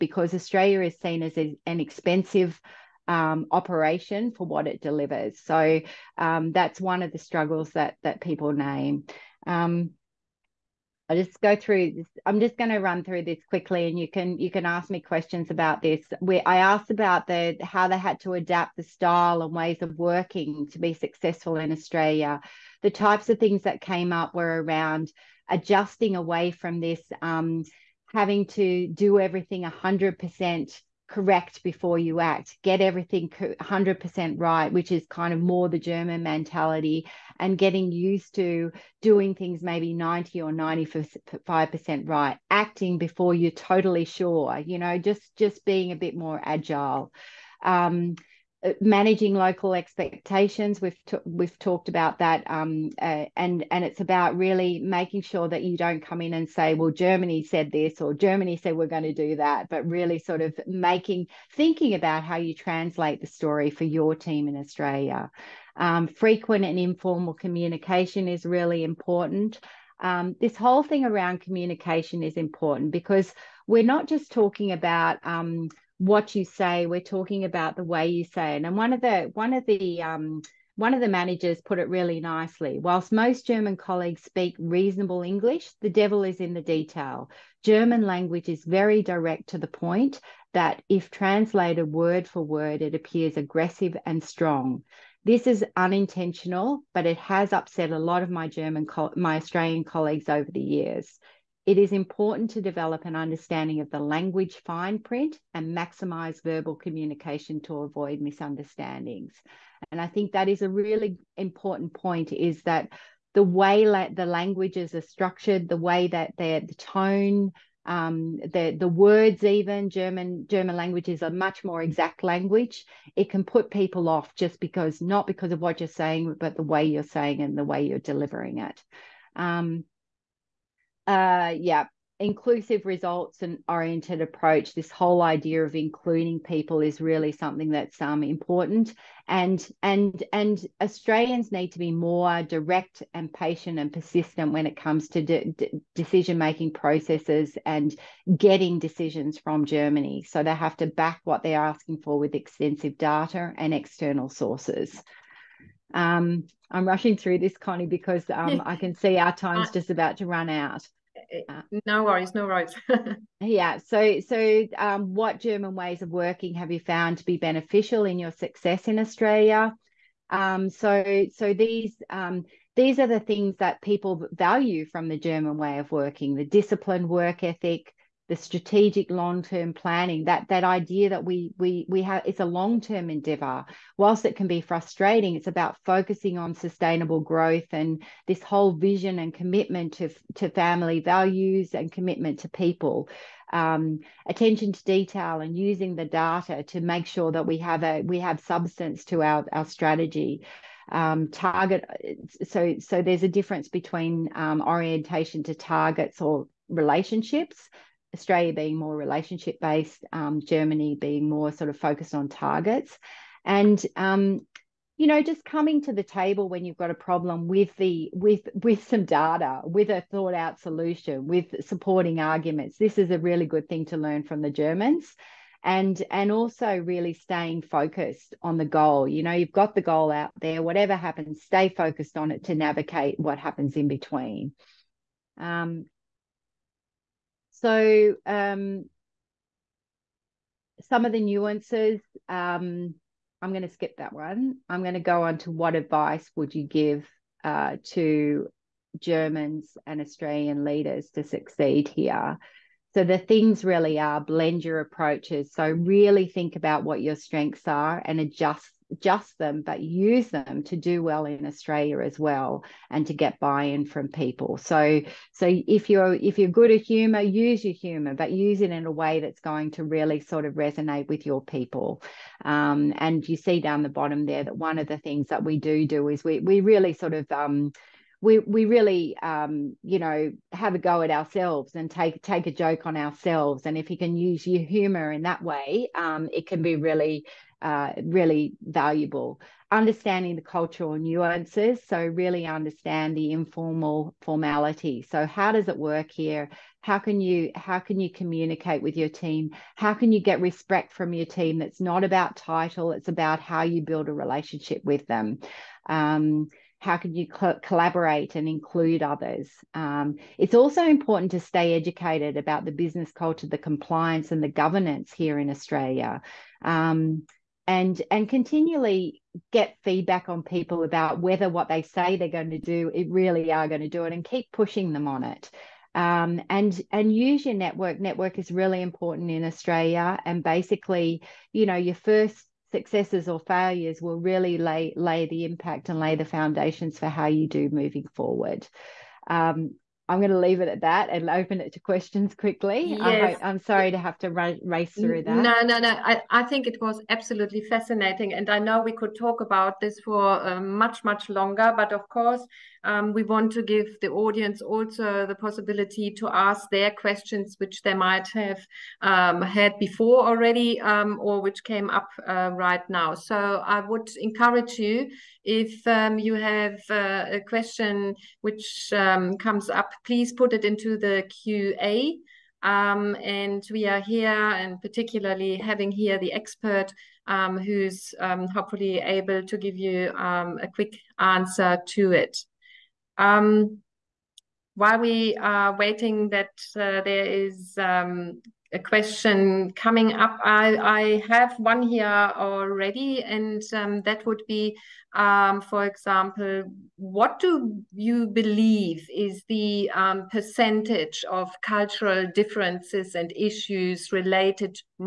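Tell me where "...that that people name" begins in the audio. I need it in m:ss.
0:07.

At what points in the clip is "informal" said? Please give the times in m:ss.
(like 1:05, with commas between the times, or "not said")
1:06, 4:53.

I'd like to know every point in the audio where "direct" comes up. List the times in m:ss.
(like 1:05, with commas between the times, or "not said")
1:29, 2:22.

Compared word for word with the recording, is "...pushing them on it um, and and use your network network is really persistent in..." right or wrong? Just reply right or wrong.
wrong.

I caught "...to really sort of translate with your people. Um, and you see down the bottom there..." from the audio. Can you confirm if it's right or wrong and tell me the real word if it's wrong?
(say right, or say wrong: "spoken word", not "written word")
wrong: "resonate", not "translate".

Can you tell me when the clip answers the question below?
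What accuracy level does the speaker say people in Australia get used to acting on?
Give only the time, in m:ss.
0:39.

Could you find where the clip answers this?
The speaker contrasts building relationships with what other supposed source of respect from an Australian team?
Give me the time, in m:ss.
5:02.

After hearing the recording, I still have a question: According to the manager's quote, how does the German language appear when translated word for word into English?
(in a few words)
Aggressive and strong.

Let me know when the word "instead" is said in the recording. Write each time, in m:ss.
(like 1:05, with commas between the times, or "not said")
not said.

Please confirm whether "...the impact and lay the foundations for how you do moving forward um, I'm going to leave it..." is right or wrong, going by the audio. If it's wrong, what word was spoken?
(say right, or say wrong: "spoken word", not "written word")
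right.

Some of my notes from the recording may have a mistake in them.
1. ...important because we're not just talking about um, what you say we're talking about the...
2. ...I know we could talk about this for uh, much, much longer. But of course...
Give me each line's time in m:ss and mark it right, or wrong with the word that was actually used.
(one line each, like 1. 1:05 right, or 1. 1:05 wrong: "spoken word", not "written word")
1. 1:12 right
2. 5:48 right.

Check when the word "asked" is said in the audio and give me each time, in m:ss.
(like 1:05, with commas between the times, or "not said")
0:16.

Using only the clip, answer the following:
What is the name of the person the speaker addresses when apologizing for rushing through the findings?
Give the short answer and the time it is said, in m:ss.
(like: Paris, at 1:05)
Connie, at 2:37.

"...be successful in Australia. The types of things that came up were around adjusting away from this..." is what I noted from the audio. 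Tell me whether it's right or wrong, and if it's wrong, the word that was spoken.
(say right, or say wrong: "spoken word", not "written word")
right.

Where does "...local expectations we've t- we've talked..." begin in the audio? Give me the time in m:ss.
0:49.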